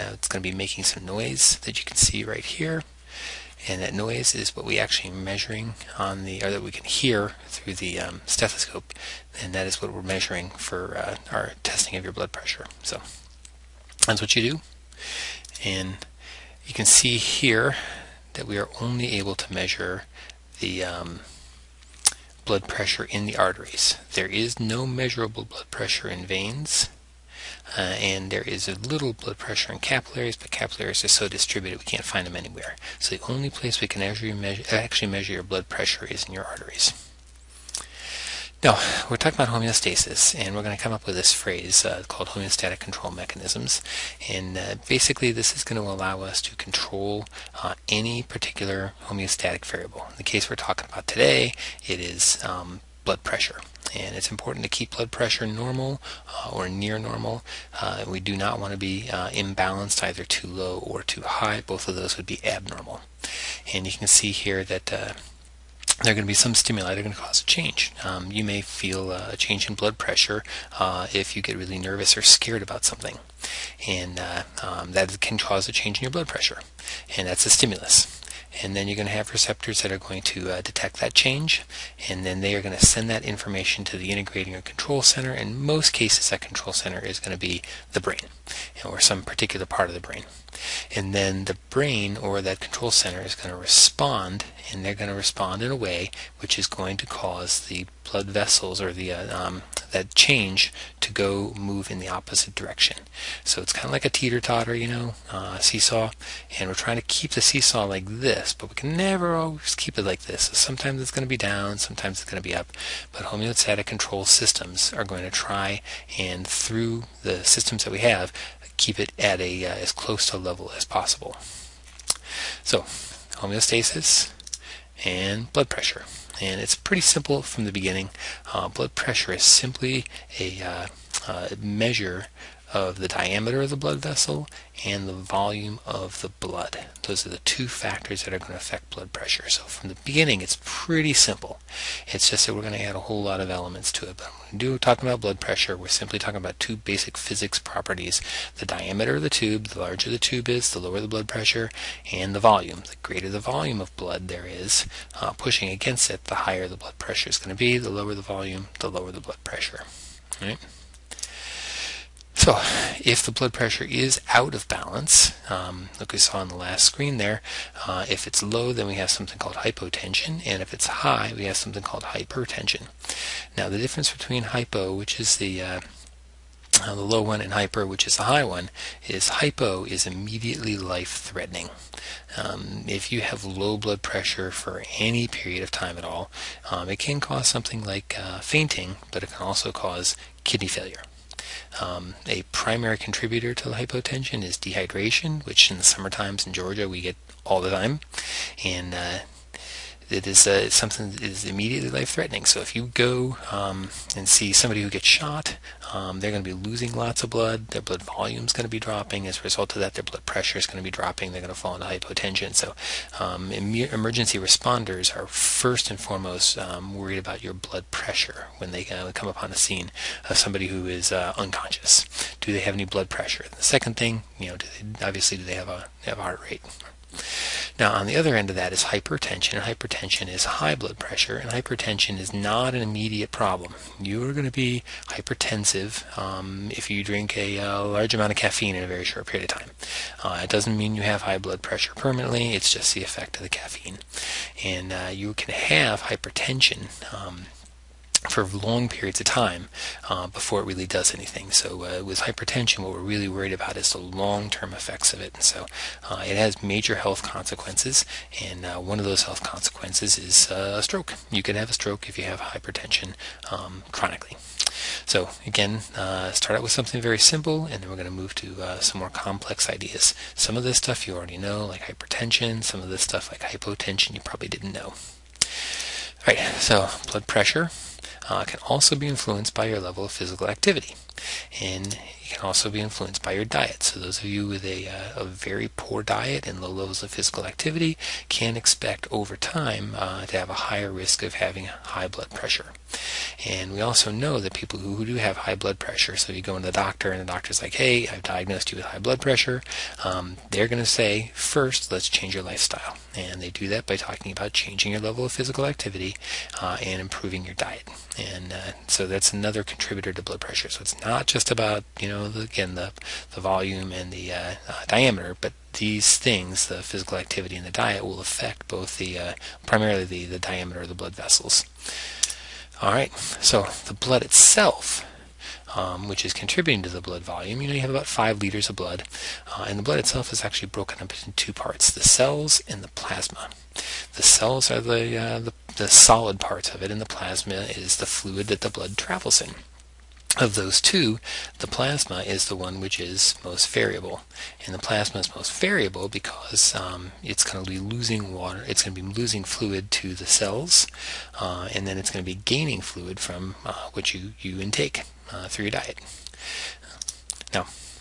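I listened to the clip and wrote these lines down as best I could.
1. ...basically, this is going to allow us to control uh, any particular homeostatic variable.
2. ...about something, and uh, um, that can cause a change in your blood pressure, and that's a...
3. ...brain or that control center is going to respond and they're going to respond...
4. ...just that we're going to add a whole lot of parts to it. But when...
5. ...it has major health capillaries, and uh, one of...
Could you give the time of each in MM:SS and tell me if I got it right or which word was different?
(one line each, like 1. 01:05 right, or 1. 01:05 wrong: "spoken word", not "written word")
1. 00:44 right
2. 01:12 right
3. 01:31 right
4. 02:22 wrong: "elements", not "parts"
5. 04:16 wrong: "consequences", not "capillaries".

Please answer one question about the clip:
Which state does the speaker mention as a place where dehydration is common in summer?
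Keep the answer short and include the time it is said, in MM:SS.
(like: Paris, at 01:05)
Georgia, at 03:16.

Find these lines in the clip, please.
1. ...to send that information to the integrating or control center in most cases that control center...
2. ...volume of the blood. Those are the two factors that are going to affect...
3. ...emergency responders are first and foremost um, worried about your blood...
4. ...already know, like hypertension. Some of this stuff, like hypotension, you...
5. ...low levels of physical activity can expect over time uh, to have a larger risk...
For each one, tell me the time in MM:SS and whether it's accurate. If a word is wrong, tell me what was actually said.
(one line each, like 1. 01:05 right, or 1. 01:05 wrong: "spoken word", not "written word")
1. 01:22 right
2. 02:15 right
3. 03:33 right
4. 04:31 right
5. 04:46 wrong: "higher", not "larger".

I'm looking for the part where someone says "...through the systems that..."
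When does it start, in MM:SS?
01:56.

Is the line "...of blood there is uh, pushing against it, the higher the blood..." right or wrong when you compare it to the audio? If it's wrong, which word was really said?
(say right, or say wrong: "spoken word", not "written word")
right.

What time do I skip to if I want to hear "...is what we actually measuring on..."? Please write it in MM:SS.
00:04.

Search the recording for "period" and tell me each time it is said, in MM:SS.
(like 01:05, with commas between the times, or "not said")
03:05, 03:59, 04:08.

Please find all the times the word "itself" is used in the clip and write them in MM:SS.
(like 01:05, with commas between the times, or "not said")
05:24, 05:29.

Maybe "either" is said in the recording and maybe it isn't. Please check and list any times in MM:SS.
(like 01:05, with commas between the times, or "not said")
01:00.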